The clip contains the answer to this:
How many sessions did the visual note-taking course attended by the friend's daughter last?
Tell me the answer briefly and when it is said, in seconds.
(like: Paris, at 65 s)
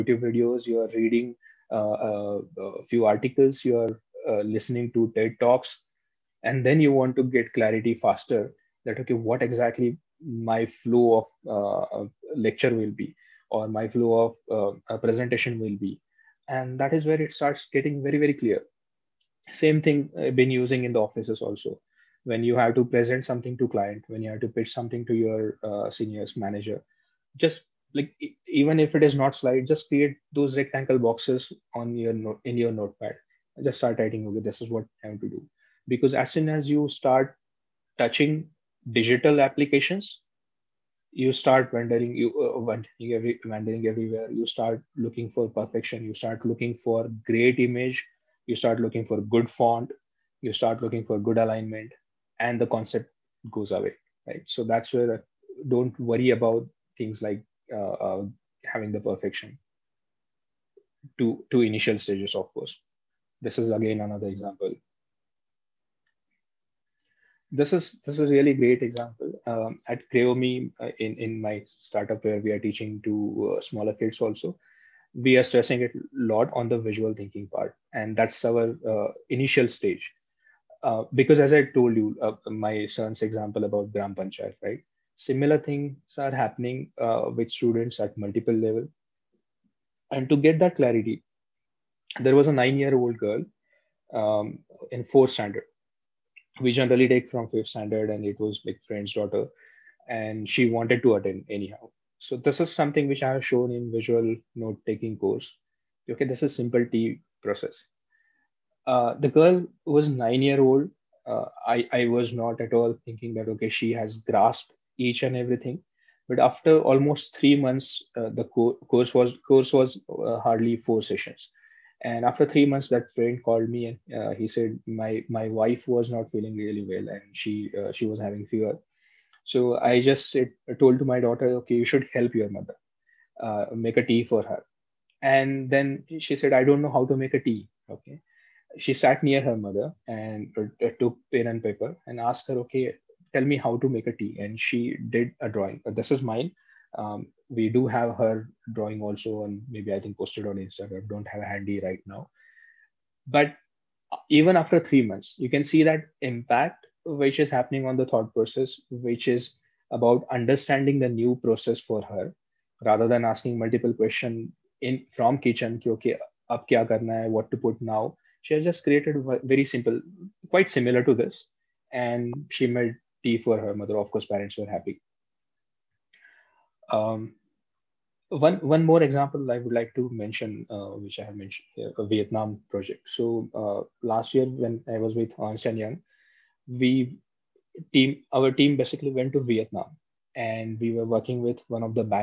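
4, at 120 s.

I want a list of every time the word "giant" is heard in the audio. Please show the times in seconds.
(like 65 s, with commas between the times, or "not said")
not said.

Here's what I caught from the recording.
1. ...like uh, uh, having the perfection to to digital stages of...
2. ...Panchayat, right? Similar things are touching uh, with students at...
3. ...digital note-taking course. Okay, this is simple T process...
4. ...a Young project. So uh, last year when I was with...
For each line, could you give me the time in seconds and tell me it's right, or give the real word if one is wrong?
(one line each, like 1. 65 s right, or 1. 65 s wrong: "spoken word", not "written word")
1. 57 s wrong: "initial", not "digital"
2. 84 s wrong: "happening", not "touching"
3. 103 s wrong: "visual", not "digital"
4. 182 s wrong: "Vietnam", not "Young".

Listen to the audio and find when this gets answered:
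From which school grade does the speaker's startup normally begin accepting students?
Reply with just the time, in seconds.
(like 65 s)
97 s.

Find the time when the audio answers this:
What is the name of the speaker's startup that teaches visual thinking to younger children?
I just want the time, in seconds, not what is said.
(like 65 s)
70 s.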